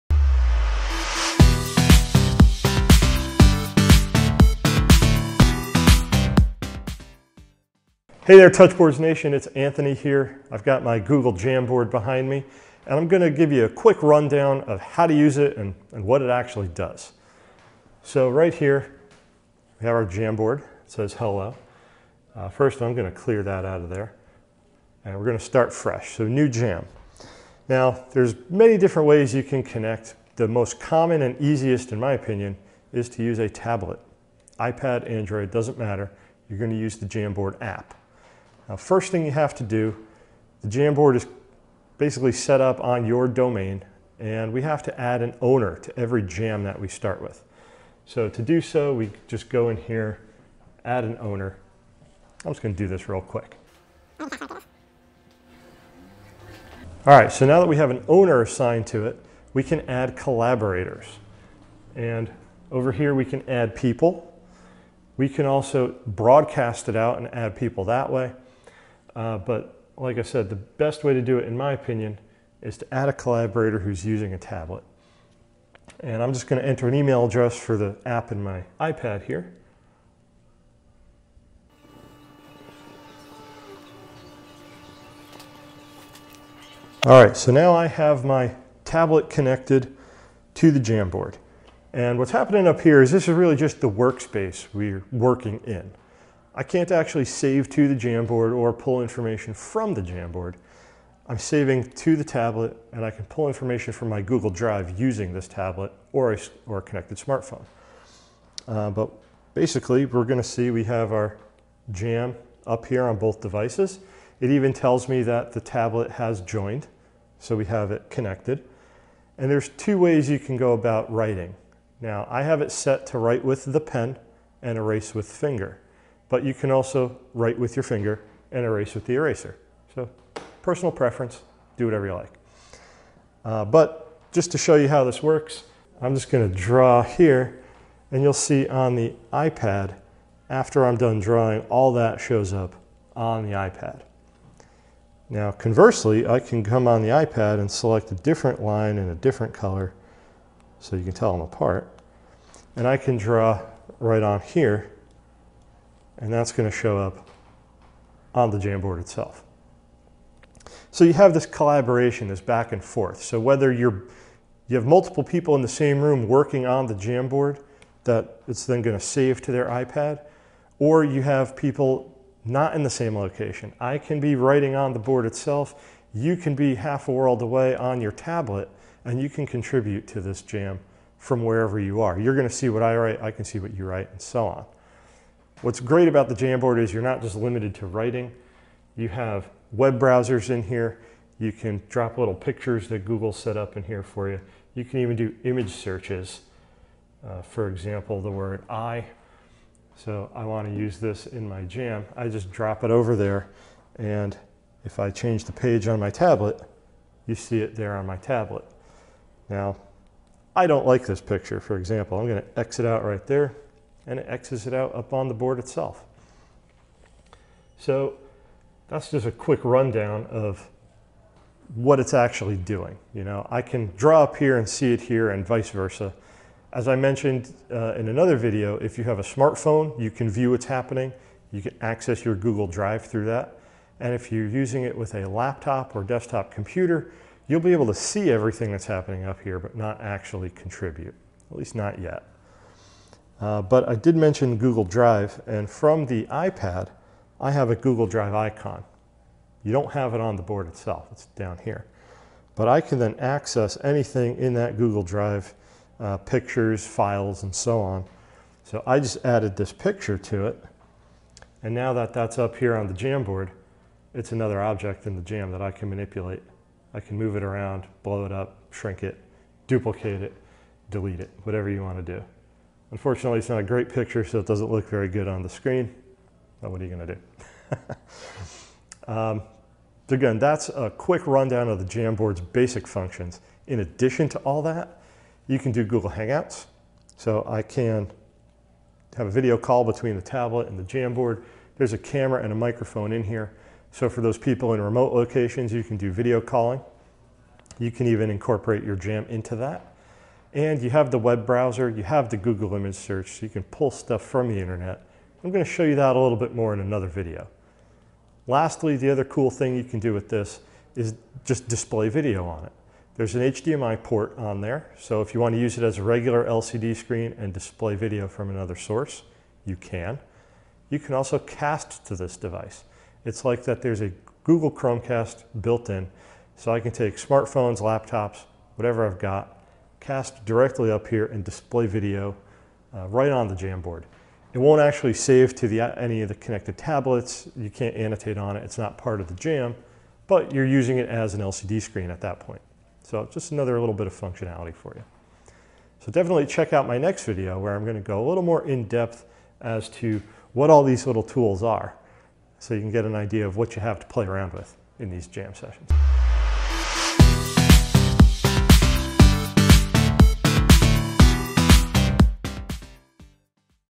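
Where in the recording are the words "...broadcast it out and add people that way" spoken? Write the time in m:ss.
1:06.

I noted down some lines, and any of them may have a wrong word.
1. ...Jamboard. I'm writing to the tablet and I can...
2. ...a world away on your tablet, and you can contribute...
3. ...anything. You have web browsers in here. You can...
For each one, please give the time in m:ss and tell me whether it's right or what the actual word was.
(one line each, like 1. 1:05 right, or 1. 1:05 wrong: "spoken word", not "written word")
1. 1:40 wrong: "saving", not "writing"
2. 2:57 right
3. 3:07 wrong: "writing", not "anything".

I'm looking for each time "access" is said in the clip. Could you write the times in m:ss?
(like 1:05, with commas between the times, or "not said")
3:51, 4:13.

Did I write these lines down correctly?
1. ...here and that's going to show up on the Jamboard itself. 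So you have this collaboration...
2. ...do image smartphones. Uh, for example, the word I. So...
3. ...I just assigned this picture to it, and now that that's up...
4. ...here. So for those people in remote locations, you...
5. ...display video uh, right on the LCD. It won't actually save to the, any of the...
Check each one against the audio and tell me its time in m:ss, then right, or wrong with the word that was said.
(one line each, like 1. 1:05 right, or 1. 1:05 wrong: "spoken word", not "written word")
1. 2:34 right
2. 3:15 wrong: "searches", not "smartphones"
3. 4:18 wrong: "added", not "assigned"
4. 4:53 right
5. 5:31 wrong: "Jamboard", not "LCD".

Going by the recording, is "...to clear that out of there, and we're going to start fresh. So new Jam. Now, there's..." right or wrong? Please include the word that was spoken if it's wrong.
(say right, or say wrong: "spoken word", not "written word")
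right.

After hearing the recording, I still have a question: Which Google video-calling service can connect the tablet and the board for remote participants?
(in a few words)
Google Hangouts.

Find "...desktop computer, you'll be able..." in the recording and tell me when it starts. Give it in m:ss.
3:56.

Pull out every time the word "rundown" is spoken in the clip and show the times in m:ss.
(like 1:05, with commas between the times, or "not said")
0:14, 3:39, 4:41.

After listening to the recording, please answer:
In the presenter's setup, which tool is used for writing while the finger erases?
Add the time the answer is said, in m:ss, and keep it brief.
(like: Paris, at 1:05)
The pen, at 2:03.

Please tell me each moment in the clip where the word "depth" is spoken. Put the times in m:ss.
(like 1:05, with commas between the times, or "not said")
5:48.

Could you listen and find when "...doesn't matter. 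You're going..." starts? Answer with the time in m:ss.
0:35.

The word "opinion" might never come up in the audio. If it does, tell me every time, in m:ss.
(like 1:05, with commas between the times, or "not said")
0:32, 1:11.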